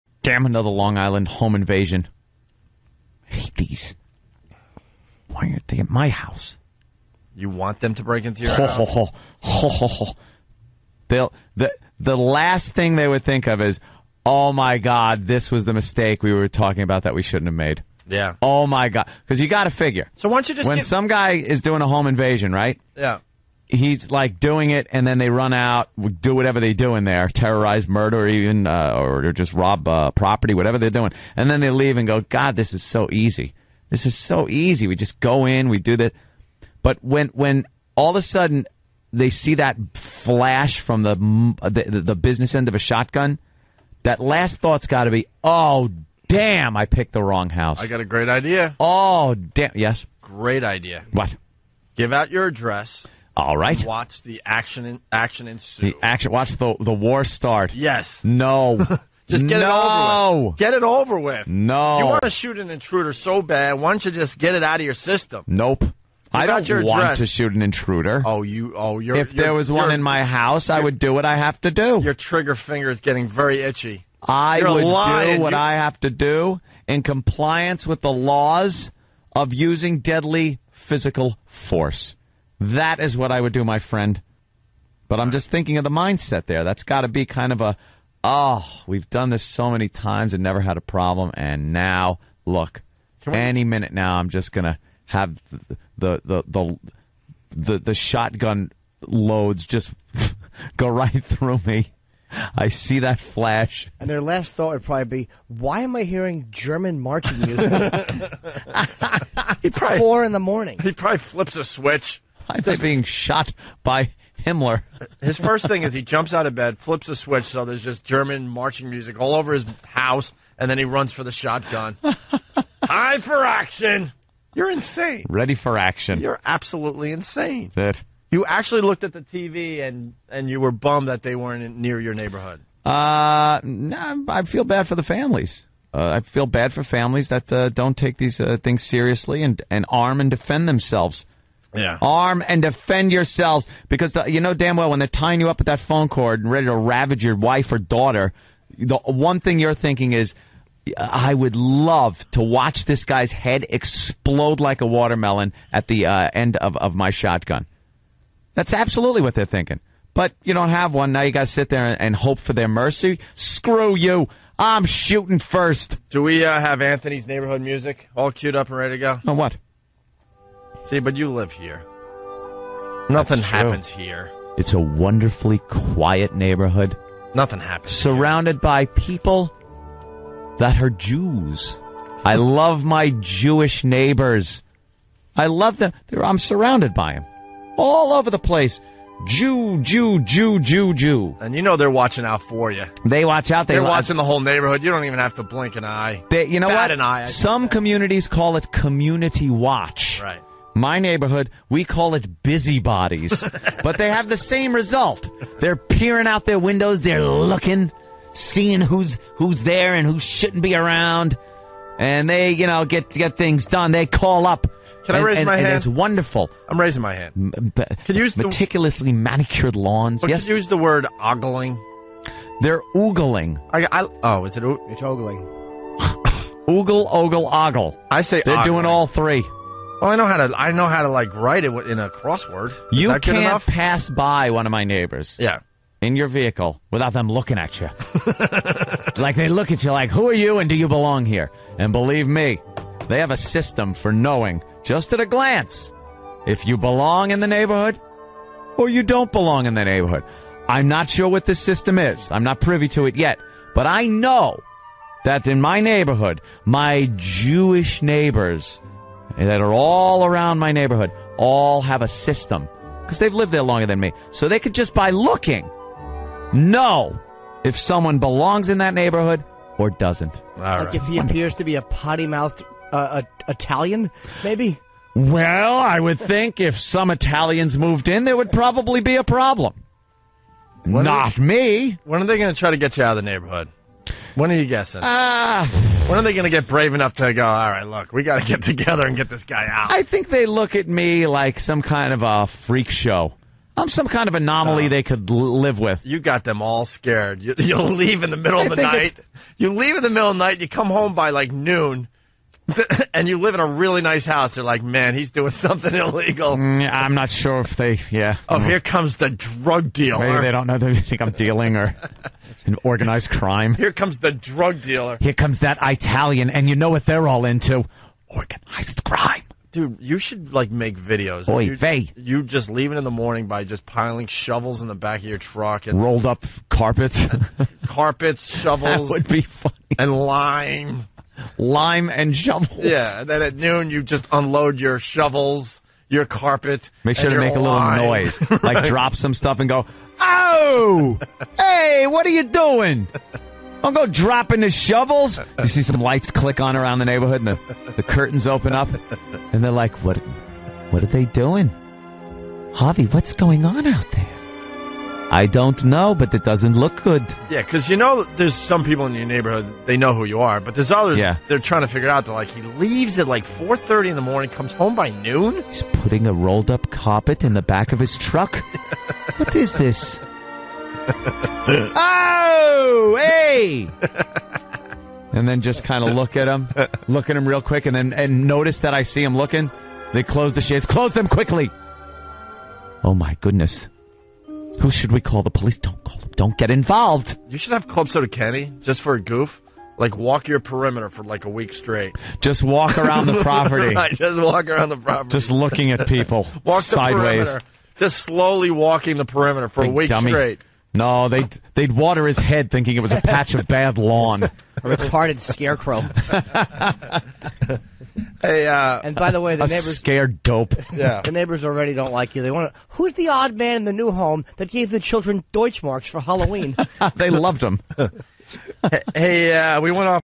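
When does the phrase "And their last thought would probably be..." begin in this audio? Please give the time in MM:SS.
01:43.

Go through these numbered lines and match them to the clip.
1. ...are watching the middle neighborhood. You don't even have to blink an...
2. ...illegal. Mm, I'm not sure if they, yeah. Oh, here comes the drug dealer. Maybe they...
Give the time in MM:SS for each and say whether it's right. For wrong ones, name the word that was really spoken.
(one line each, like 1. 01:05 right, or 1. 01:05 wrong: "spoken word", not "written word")
1. 03:13 wrong: "whole", not "middle"
2. 05:05 right.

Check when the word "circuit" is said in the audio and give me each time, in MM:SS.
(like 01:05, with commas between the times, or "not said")
not said.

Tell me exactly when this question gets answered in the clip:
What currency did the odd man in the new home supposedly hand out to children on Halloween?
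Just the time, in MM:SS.
06:55.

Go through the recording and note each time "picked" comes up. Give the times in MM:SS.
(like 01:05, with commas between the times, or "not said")
00:46.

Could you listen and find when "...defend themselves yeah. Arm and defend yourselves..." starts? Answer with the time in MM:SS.
02:20.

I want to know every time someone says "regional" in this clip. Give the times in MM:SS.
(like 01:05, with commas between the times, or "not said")
not said.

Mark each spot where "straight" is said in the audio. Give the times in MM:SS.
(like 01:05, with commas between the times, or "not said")
06:31, 06:40.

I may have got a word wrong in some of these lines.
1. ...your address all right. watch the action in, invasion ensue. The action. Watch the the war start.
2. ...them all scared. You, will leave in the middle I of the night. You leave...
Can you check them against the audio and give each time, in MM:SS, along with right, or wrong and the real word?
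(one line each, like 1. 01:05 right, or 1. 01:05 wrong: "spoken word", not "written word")
1. 00:52 wrong: "action", not "invasion"
2. 04:56 right.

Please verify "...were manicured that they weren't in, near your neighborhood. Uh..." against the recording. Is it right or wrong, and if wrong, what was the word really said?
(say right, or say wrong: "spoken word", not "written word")
wrong: "bummed", not "manicured".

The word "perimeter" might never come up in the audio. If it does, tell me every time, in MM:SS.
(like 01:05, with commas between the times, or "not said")
06:30, 06:39.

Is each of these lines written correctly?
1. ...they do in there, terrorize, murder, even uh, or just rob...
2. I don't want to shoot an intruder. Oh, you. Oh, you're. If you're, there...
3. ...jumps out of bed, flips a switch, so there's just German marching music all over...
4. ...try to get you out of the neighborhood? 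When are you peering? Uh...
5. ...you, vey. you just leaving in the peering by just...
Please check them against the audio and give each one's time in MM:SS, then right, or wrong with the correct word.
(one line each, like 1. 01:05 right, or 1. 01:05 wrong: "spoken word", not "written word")
1. 00:26 right
2. 01:06 right
3. 01:56 right
4. 04:42 wrong: "guessing", not "peering"
5. 05:21 wrong: "morning", not "peering".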